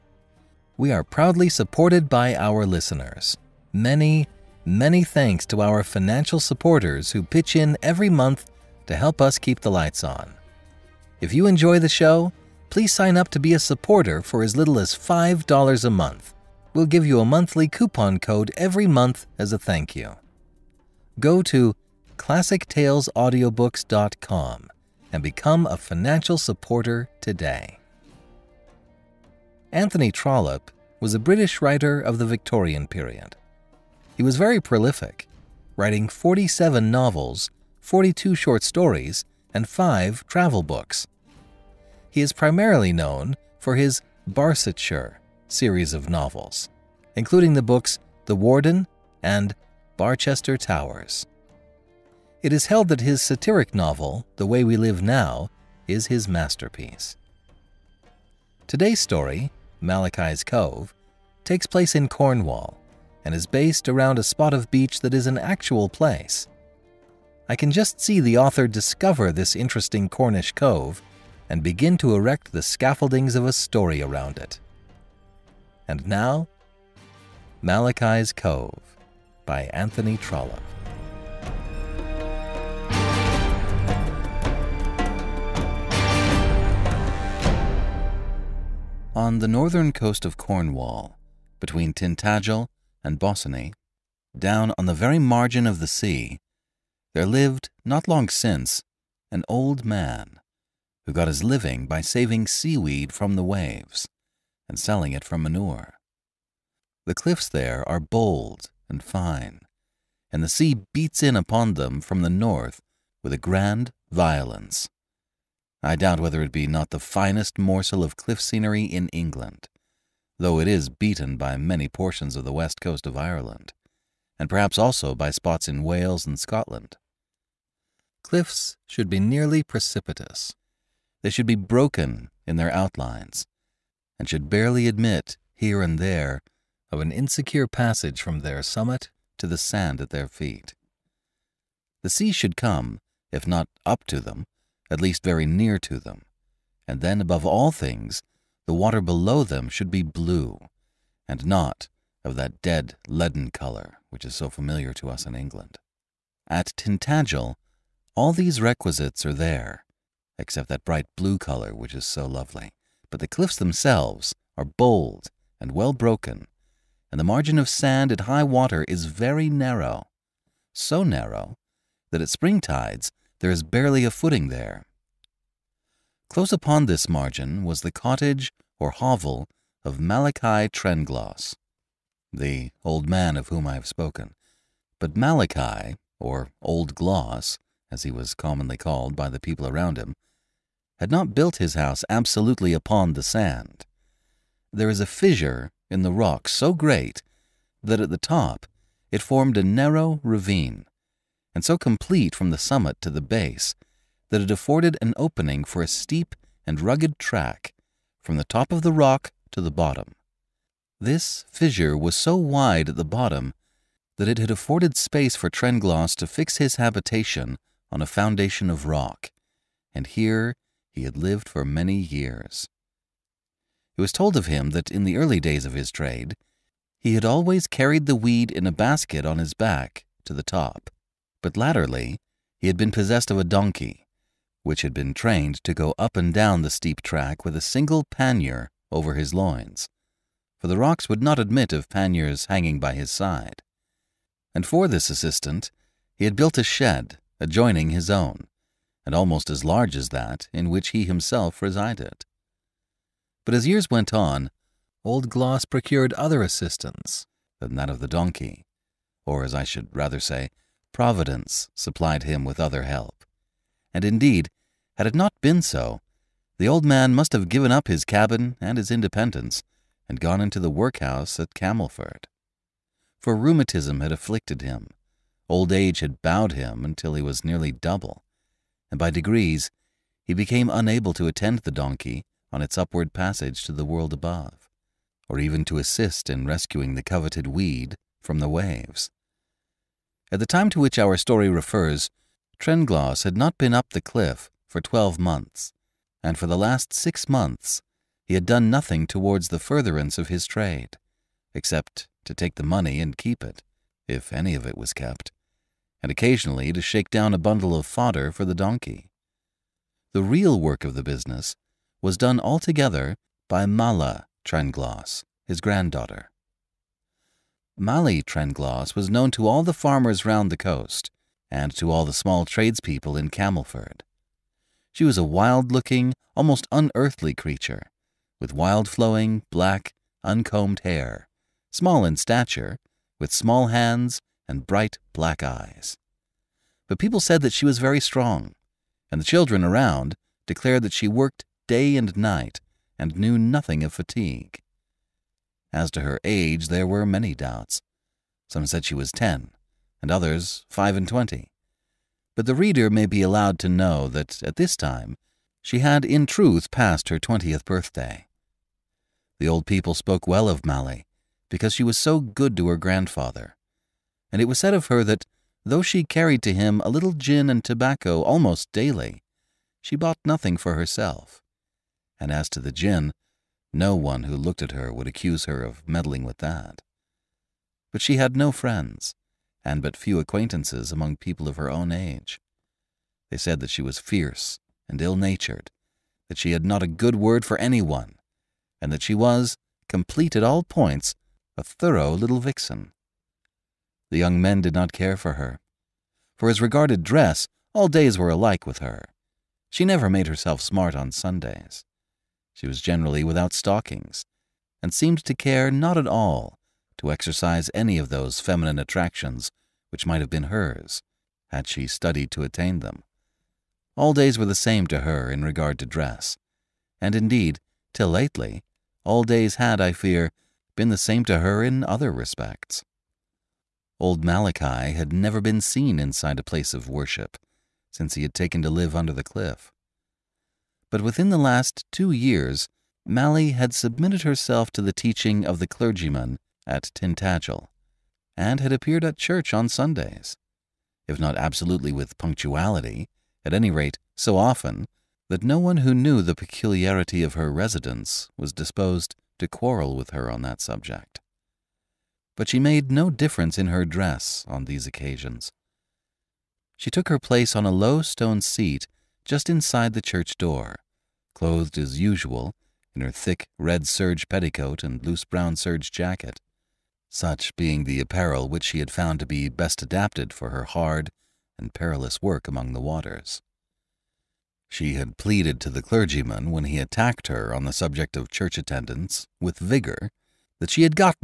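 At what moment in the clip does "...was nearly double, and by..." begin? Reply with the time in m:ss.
4:37.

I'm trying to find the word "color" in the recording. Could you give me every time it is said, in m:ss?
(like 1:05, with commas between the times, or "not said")
2:33, 2:41.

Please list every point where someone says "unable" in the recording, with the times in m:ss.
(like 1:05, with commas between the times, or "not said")
4:40.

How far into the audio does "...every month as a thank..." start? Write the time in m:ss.
0:18.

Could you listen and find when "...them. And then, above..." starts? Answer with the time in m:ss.
2:25.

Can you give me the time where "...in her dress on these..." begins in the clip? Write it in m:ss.
7:33.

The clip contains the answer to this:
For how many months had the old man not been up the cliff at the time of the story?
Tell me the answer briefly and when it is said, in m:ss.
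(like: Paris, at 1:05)
12, at 4:54.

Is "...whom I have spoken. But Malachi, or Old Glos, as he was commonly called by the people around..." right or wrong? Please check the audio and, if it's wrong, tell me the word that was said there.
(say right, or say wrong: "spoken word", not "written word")
right.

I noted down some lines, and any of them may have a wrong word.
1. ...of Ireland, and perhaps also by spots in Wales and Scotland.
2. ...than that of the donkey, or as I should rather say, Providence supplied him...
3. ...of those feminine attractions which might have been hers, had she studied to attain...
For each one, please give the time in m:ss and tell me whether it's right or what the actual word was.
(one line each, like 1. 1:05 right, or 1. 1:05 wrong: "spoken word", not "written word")
1. 2:03 right
2. 4:17 right
3. 6:47 right.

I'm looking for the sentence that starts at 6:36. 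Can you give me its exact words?
For as regarded dress, all days were alike with her.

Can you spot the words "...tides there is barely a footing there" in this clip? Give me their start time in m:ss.
2:52.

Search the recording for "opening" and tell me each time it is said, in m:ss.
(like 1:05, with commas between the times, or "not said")
3:25.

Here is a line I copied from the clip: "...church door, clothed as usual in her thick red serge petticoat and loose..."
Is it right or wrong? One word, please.
right.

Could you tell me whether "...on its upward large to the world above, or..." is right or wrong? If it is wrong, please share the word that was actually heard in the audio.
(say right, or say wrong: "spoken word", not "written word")
wrong: "passage", not "large".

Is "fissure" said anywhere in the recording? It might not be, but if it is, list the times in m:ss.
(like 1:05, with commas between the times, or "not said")
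3:15, 3:31.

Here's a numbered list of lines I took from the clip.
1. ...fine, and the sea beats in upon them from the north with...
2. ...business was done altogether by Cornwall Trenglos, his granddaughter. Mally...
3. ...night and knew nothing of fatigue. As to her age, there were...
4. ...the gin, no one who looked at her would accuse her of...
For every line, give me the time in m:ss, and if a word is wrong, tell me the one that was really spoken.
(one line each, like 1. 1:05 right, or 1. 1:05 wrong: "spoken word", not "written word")
1. 1:49 right
2. 5:11 wrong: "Mally", not "Cornwall"
3. 5:42 right
4. 6:12 right.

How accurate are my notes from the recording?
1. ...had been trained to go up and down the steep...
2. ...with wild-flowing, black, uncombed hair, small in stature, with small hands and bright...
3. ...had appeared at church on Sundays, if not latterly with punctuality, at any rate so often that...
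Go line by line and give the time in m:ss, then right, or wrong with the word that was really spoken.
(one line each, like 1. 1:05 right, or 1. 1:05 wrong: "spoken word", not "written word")
1. 3:54 right
2. 5:28 right
3. 7:18 wrong: "absolutely", not "latterly".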